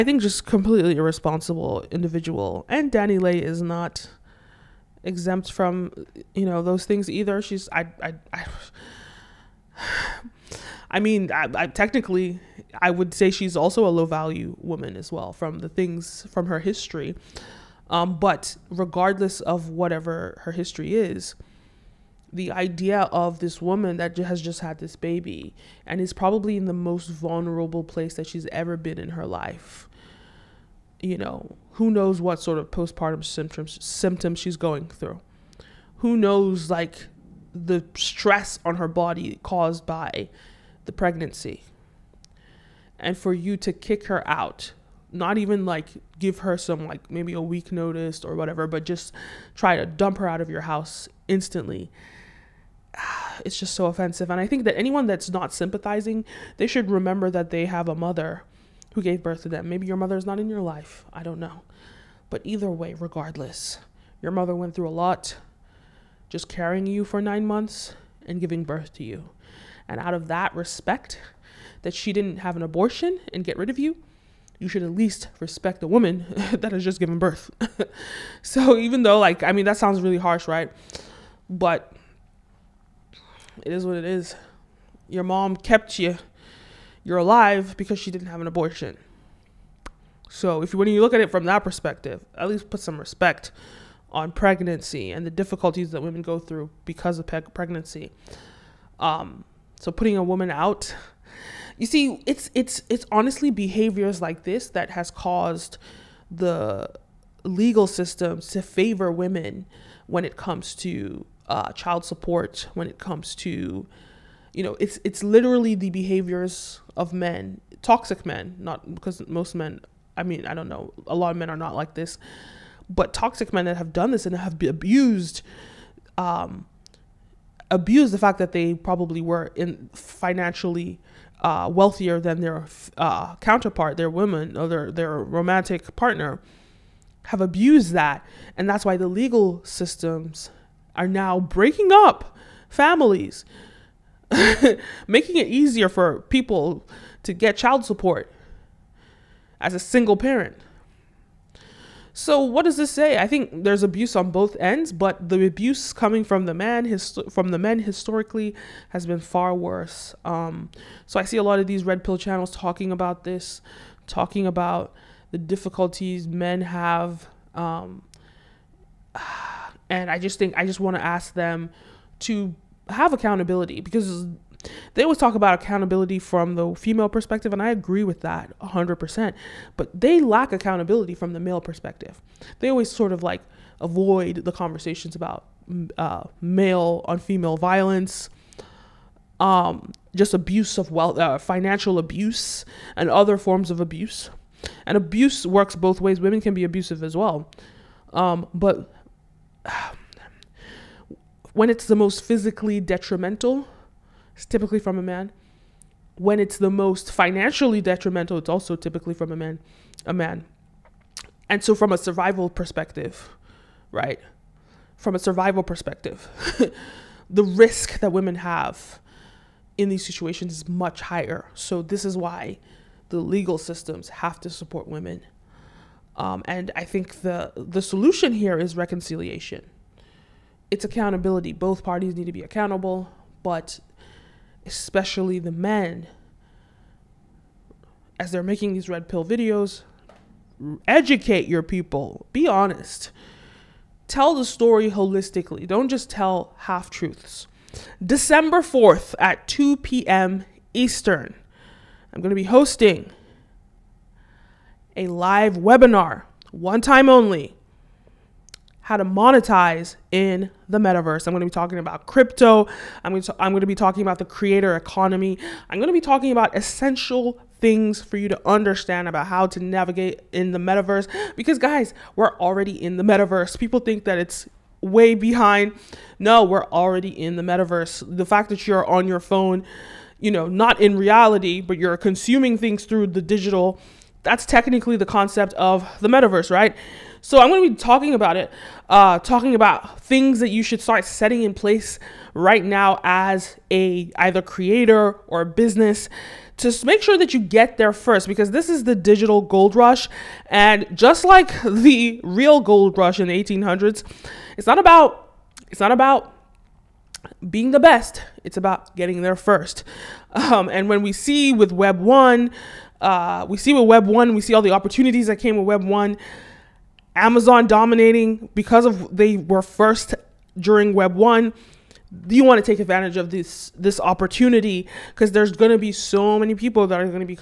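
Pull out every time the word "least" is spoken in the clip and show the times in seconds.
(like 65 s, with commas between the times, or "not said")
74 s, 92 s.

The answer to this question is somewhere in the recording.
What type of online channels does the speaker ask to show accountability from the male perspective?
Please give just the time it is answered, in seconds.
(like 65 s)
161 s.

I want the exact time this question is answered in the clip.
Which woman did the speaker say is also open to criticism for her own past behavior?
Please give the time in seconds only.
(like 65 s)
2 s.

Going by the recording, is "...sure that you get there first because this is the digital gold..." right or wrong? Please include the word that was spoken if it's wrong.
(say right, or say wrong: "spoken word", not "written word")
right.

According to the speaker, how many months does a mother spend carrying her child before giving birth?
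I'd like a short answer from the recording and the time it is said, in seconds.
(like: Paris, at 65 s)
9, at 67 s.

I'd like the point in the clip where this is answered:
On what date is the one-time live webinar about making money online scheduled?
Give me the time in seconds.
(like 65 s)
248 s.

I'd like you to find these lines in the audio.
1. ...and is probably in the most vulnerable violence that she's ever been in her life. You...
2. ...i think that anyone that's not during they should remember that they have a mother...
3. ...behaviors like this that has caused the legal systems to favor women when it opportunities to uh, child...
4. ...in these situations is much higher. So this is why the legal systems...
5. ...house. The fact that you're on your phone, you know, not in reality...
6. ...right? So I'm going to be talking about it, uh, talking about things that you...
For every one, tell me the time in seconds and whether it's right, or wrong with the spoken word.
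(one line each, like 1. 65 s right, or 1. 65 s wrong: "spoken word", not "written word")
1. 25 s wrong: "place", not "violence"
2. 54 s wrong: "sympathizing", not "during"
3. 103 s wrong: "comes", not "opportunities"
4. 219 s right
5. 277 s wrong: "metaverse", not "house"
6. 286 s right.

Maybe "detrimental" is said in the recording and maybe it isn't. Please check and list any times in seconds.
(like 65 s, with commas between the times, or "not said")
202 s, 207 s.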